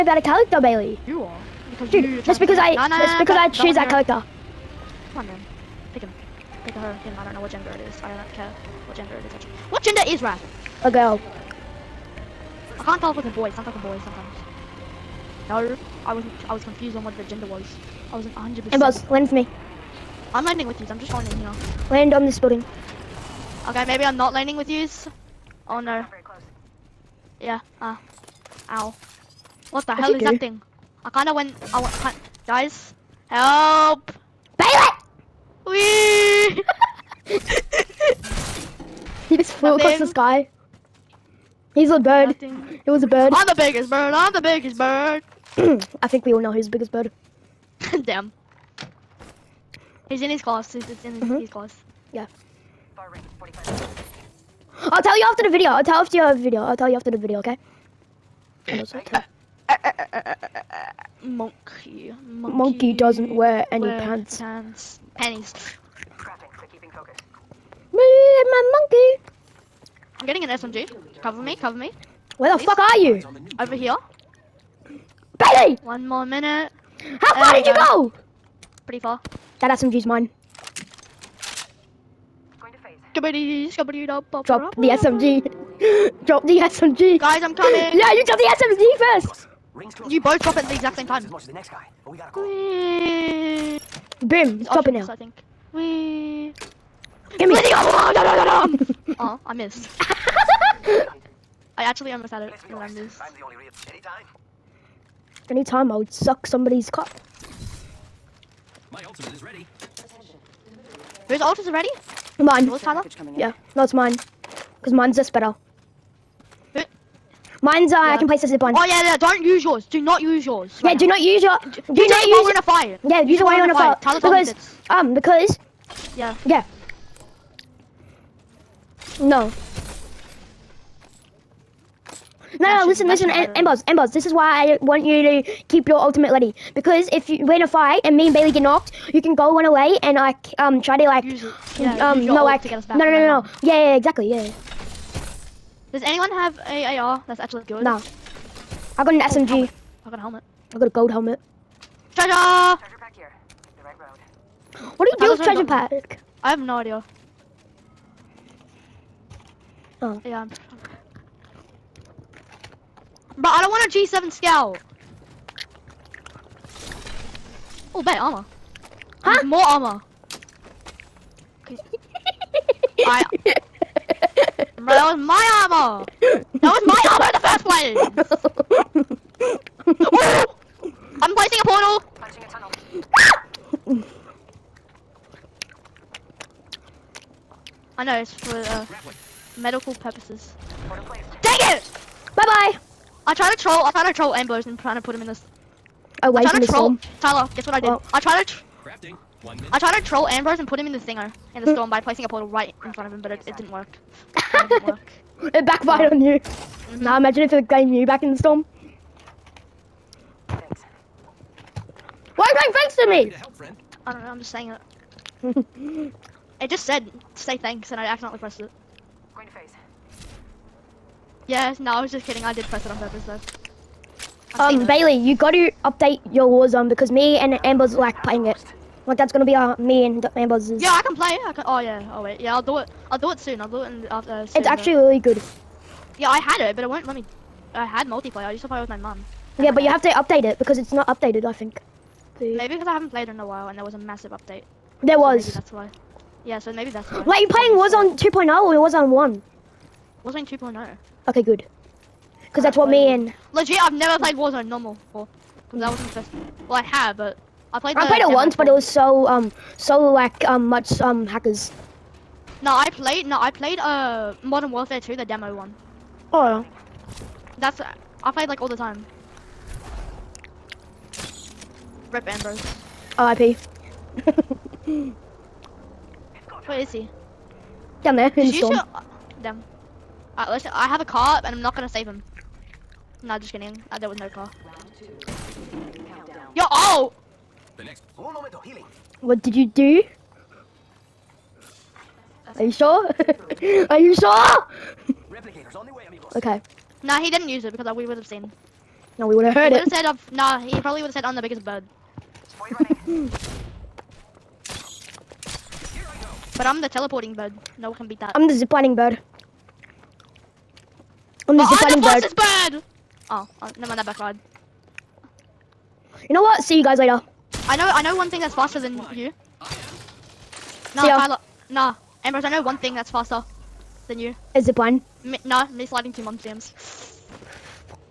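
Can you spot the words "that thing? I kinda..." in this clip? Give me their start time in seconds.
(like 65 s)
30 s.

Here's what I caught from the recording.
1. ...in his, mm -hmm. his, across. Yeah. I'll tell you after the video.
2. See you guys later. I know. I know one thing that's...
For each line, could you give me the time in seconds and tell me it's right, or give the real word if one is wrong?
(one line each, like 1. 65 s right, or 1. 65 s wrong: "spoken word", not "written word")
1. 51 s wrong: "class", not "across"
2. 316 s right.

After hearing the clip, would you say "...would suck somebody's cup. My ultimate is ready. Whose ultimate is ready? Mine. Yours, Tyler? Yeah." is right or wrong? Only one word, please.
right.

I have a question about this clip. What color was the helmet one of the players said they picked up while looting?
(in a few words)
Gold.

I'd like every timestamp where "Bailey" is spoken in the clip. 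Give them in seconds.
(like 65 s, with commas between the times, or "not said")
0 s, 34 s, 75 s, 138 s, 224 s.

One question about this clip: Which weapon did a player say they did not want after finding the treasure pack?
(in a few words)
G7 Scout.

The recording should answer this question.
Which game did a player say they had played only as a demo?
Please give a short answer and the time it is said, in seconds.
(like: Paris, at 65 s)
Modern Warfare 2, at 264 s.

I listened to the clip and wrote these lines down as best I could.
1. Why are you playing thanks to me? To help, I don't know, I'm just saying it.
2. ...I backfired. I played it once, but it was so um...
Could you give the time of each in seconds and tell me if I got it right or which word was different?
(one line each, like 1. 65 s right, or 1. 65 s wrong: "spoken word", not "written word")
1. 212 s right
2. 257 s wrong: "played", not "backfired".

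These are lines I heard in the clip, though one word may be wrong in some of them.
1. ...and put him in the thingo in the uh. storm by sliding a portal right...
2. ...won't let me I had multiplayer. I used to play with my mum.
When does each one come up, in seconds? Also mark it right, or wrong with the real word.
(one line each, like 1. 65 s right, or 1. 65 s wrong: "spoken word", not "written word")
1. 200 s wrong: "placing", not "sliding"
2. 236 s right.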